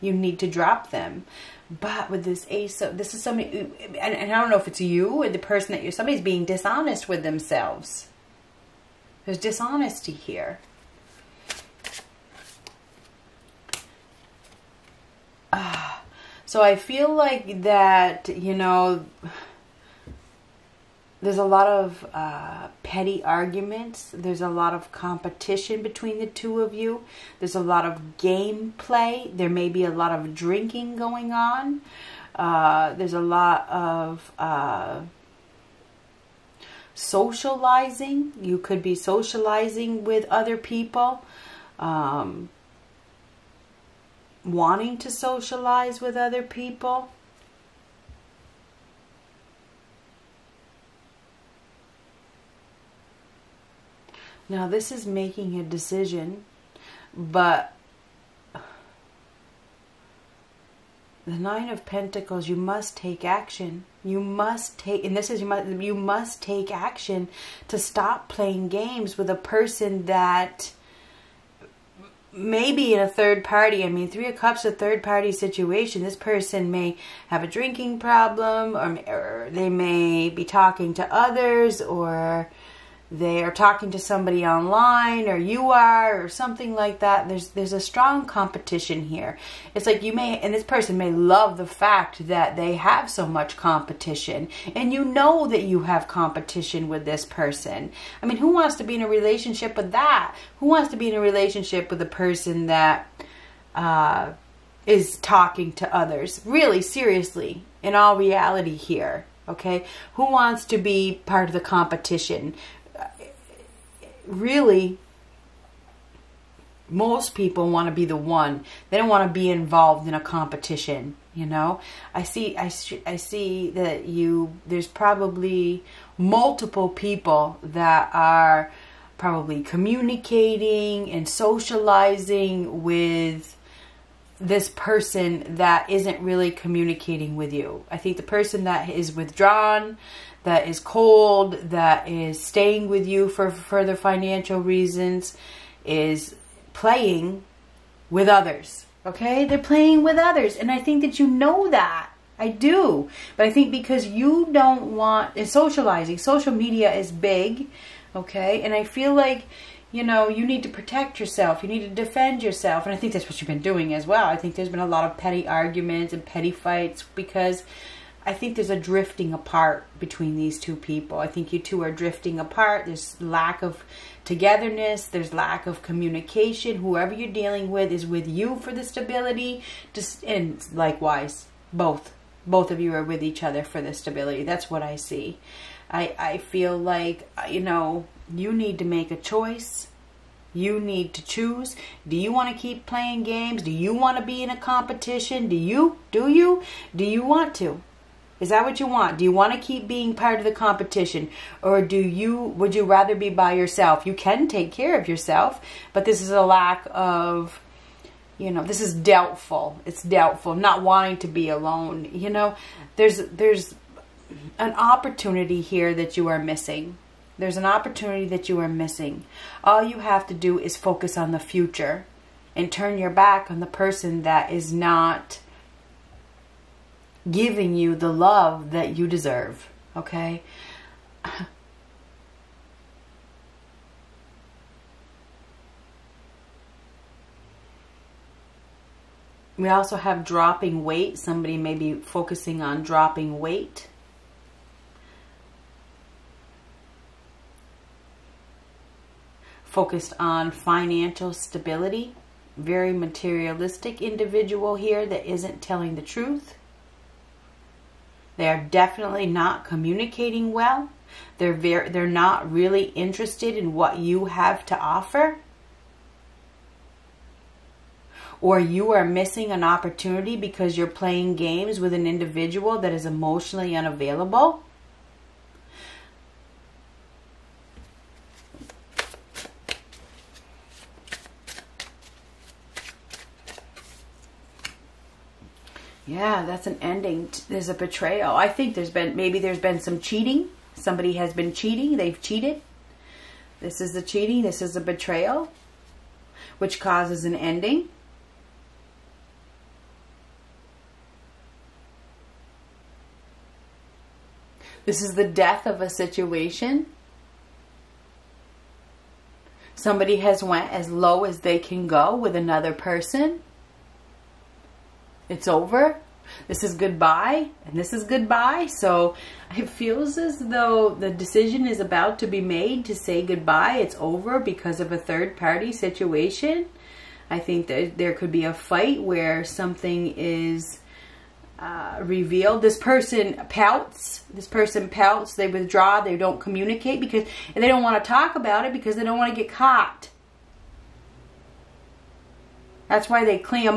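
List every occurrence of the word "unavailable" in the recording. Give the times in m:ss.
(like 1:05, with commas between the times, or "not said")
4:33.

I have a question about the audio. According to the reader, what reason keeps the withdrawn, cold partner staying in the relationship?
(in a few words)
financial reasons.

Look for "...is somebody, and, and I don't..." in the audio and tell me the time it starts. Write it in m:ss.
0:03.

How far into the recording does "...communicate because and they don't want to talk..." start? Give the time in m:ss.
5:36.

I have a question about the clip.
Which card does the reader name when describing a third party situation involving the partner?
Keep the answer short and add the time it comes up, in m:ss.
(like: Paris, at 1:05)
Three of Cups, at 1:14.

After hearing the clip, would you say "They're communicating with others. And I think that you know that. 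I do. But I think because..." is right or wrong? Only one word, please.
wrong.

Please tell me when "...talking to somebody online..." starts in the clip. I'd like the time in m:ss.
1:23.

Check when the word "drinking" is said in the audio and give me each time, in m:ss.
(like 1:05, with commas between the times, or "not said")
0:30, 1:17.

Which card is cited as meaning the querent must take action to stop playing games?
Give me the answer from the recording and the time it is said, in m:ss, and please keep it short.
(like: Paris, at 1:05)
Nine of Pentacles, at 1:01.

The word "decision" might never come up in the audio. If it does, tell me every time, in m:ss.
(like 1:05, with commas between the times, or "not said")
0:55, 5:21.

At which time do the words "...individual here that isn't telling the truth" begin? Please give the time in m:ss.
4:14.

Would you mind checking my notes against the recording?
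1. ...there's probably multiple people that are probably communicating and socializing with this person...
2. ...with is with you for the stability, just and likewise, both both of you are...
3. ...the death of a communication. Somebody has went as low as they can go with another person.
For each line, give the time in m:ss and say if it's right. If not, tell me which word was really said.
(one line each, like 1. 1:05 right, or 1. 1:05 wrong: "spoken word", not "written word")
1. 2:04 right
2. 2:57 right
3. 5:05 wrong: "situation", not "communication".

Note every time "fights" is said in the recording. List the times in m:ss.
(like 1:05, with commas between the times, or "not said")
2:46, 5:28.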